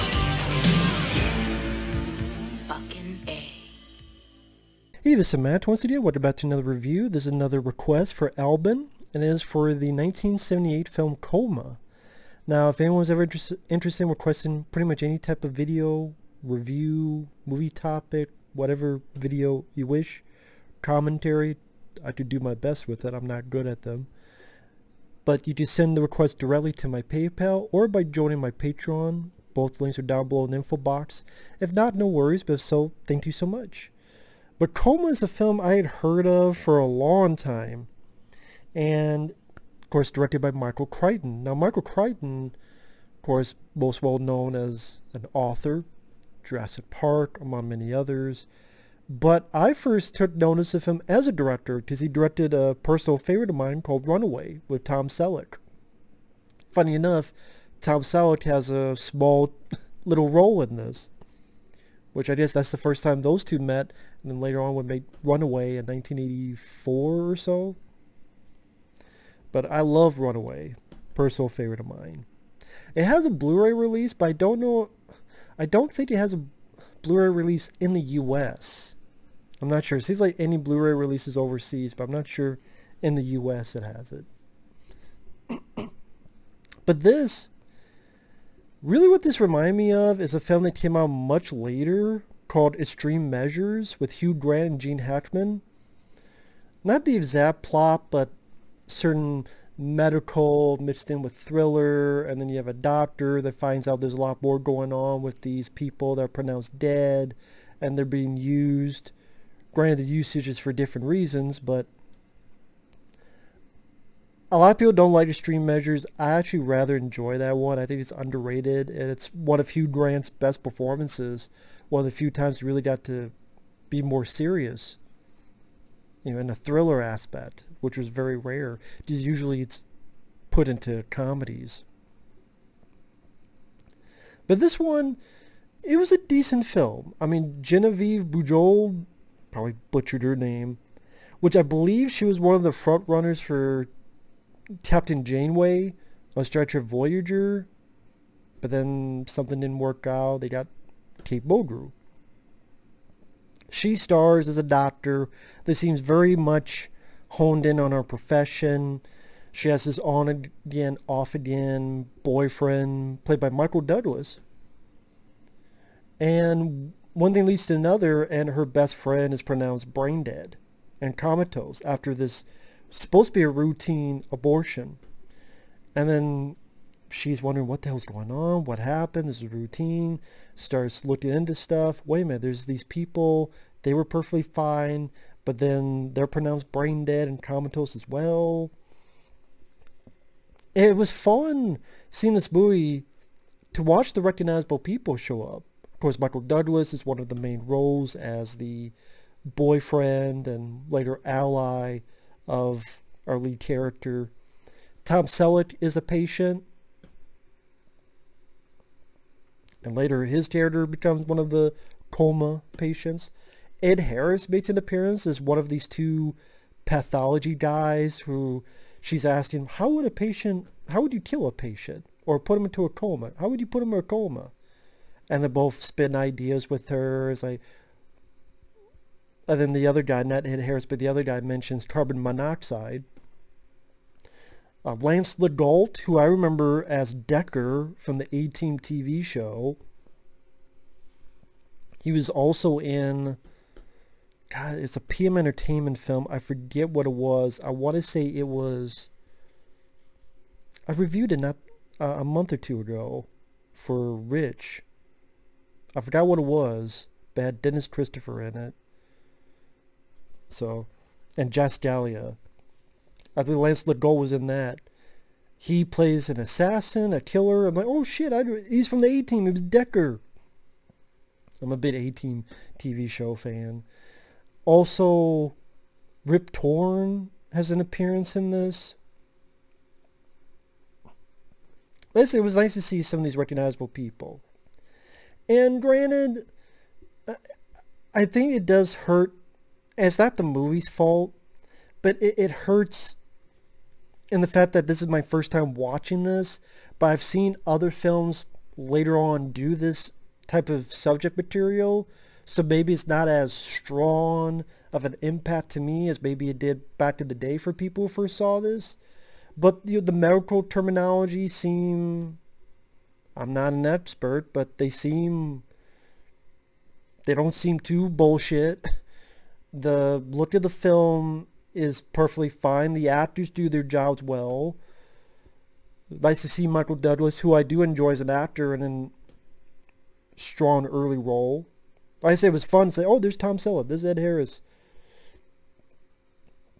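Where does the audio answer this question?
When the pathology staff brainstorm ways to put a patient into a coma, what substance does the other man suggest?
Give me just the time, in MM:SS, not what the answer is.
03:51.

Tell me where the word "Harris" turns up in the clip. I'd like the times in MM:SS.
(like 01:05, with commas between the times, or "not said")
03:34, 03:50, 05:34.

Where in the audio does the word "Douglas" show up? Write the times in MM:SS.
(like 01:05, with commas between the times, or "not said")
02:43, 03:16, 05:26.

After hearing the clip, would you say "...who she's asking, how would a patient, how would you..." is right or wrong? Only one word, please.
right.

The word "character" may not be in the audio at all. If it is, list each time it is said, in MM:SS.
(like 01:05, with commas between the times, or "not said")
03:23, 03:30.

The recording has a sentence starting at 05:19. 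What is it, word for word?
The look of the film is perfectly fine.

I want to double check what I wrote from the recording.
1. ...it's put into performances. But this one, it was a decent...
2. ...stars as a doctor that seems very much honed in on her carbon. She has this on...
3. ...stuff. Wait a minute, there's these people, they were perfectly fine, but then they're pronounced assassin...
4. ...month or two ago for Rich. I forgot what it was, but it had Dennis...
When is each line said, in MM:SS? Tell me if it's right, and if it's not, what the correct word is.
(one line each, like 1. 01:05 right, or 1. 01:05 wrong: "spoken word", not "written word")
1. 02:09 wrong: "comedies", not "performances"
2. 02:33 wrong: "profession", not "carbon"
3. 03:01 wrong: "brain", not "assassin"
4. 04:12 right.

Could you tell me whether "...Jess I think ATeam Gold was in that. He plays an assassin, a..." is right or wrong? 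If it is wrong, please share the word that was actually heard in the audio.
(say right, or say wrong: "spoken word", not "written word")
wrong: "Lance", not "ATeam".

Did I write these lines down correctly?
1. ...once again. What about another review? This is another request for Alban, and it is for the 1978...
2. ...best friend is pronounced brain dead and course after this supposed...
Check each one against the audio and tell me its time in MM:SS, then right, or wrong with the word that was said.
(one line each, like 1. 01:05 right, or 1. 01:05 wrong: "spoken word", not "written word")
1. 00:05 right
2. 02:48 wrong: "comatose", not "course".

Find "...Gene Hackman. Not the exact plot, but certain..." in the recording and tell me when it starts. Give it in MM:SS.
01:34.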